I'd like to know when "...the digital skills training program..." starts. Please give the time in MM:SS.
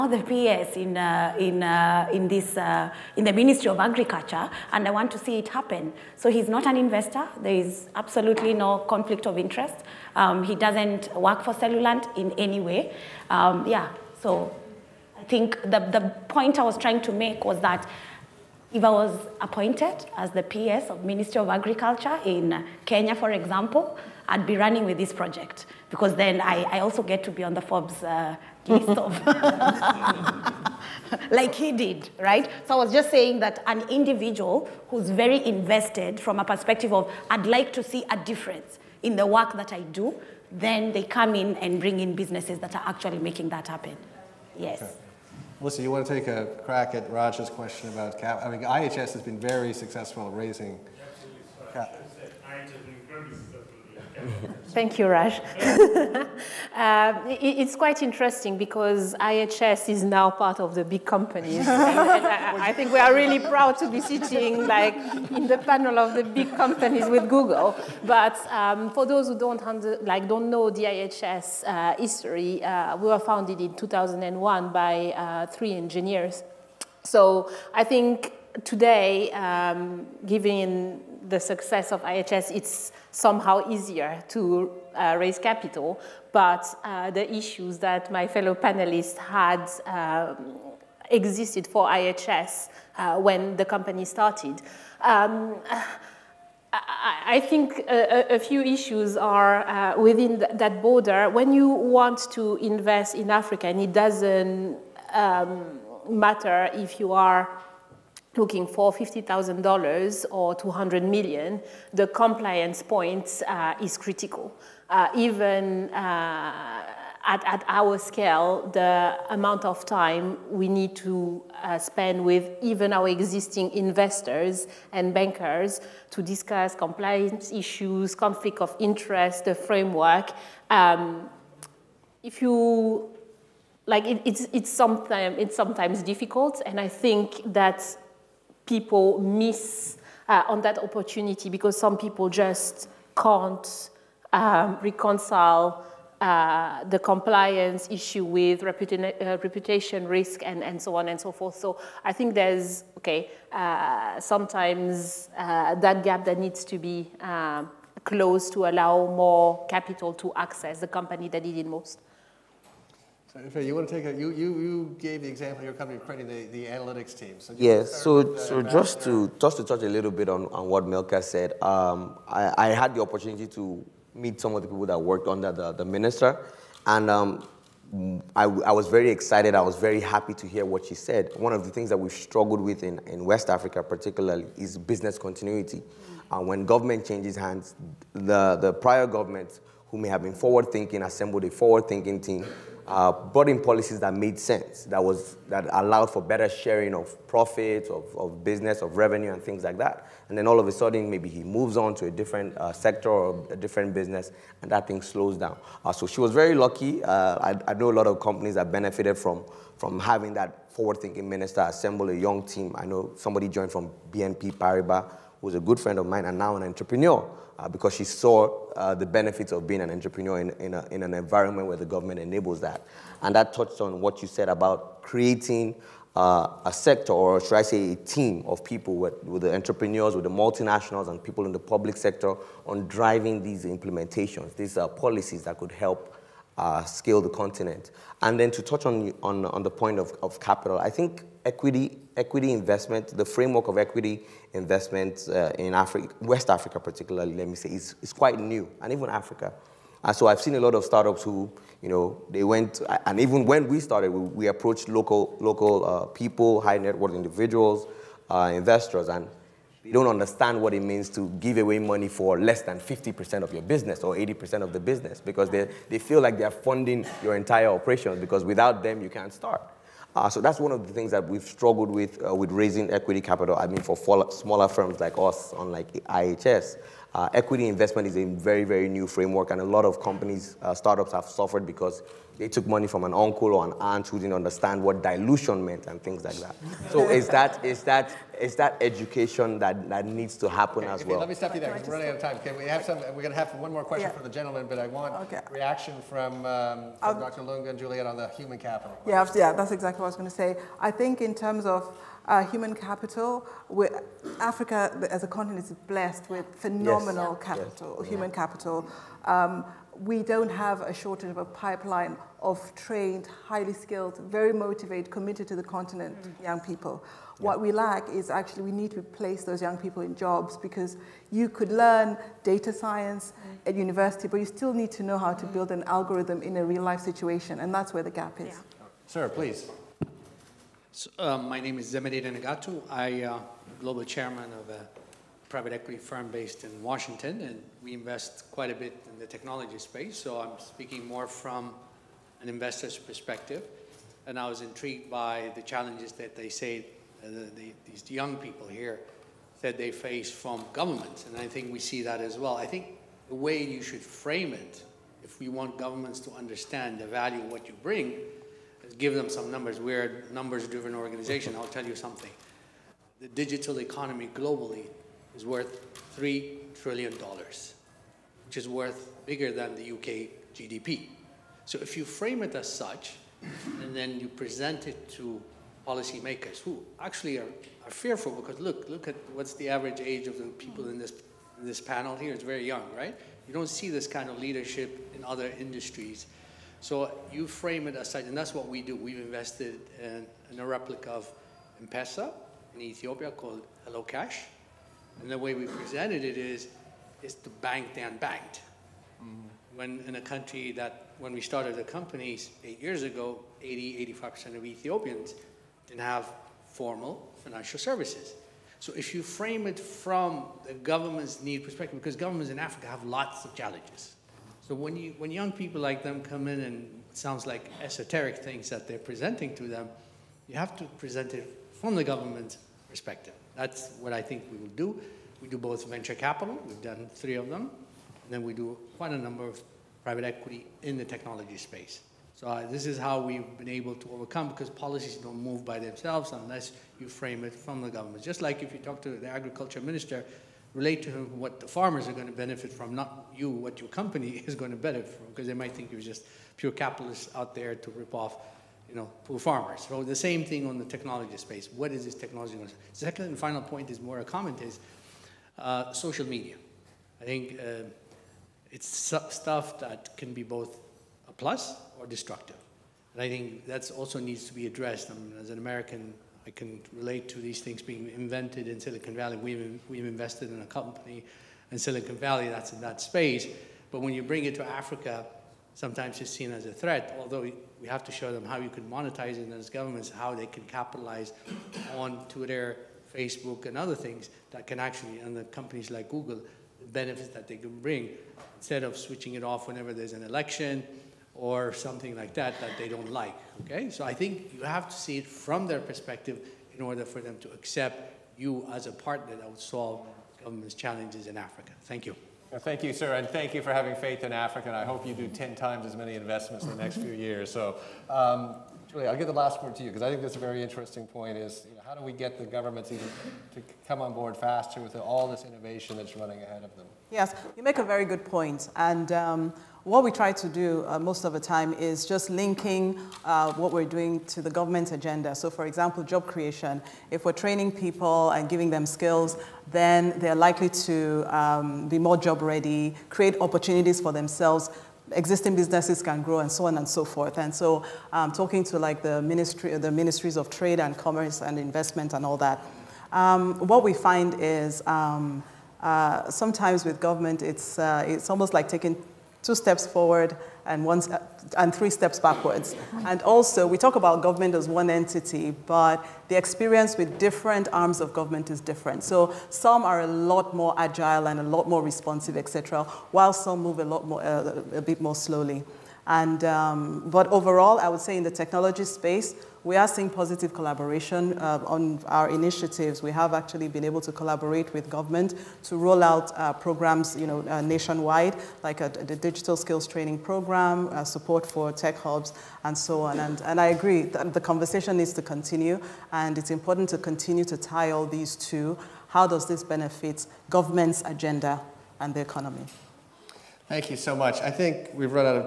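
09:38.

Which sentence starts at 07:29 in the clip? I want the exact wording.
So the same thing on the technology space.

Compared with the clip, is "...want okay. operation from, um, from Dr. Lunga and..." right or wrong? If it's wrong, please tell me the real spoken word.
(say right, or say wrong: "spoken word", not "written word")
wrong: "reaction", not "operation".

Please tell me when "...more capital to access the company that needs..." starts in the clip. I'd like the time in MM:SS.
02:39.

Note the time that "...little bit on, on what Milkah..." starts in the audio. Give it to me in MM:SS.
02:49.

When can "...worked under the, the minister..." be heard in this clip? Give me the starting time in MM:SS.
02:54.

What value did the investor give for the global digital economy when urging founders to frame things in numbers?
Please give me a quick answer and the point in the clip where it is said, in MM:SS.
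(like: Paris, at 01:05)
$3 trillion, at 06:06.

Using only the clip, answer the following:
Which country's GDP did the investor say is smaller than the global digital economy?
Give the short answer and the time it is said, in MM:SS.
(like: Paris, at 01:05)
UK, at 06:09.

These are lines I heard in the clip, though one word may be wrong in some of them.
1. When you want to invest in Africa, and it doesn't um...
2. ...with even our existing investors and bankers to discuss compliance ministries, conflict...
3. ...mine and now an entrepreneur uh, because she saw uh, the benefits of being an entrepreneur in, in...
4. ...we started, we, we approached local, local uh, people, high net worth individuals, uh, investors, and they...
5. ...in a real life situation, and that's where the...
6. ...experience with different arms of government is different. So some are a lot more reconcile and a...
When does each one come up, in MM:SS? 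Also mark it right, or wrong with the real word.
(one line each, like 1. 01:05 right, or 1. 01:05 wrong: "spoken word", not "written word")
1. 01:41 right
2. 02:02 wrong: "issues", not "ministries"
3. 03:36 right
4. 04:13 right
5. 05:26 right
6. 09:16 wrong: "agile", not "reconcile".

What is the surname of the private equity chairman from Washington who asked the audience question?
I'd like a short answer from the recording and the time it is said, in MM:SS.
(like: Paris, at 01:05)
Negatu, at 05:32.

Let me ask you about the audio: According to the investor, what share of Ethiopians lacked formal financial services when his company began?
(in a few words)
85%.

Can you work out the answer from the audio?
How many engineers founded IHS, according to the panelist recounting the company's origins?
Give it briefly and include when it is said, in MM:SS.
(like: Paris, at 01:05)
3, at 01:15.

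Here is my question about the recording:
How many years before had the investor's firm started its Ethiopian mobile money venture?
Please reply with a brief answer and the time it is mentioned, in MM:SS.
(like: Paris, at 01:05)
8, at 06:42.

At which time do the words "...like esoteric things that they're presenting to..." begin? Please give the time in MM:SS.
06:57.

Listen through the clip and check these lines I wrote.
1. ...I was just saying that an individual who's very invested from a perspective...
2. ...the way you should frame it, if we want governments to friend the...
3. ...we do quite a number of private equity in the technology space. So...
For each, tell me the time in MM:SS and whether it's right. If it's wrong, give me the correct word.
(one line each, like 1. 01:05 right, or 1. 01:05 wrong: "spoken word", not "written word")
1. 00:32 right
2. 05:53 wrong: "understand", not "friend"
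3. 07:08 right.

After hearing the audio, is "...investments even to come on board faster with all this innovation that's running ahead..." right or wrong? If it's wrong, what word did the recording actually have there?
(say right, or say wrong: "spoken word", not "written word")
wrong: "governments", not "investments".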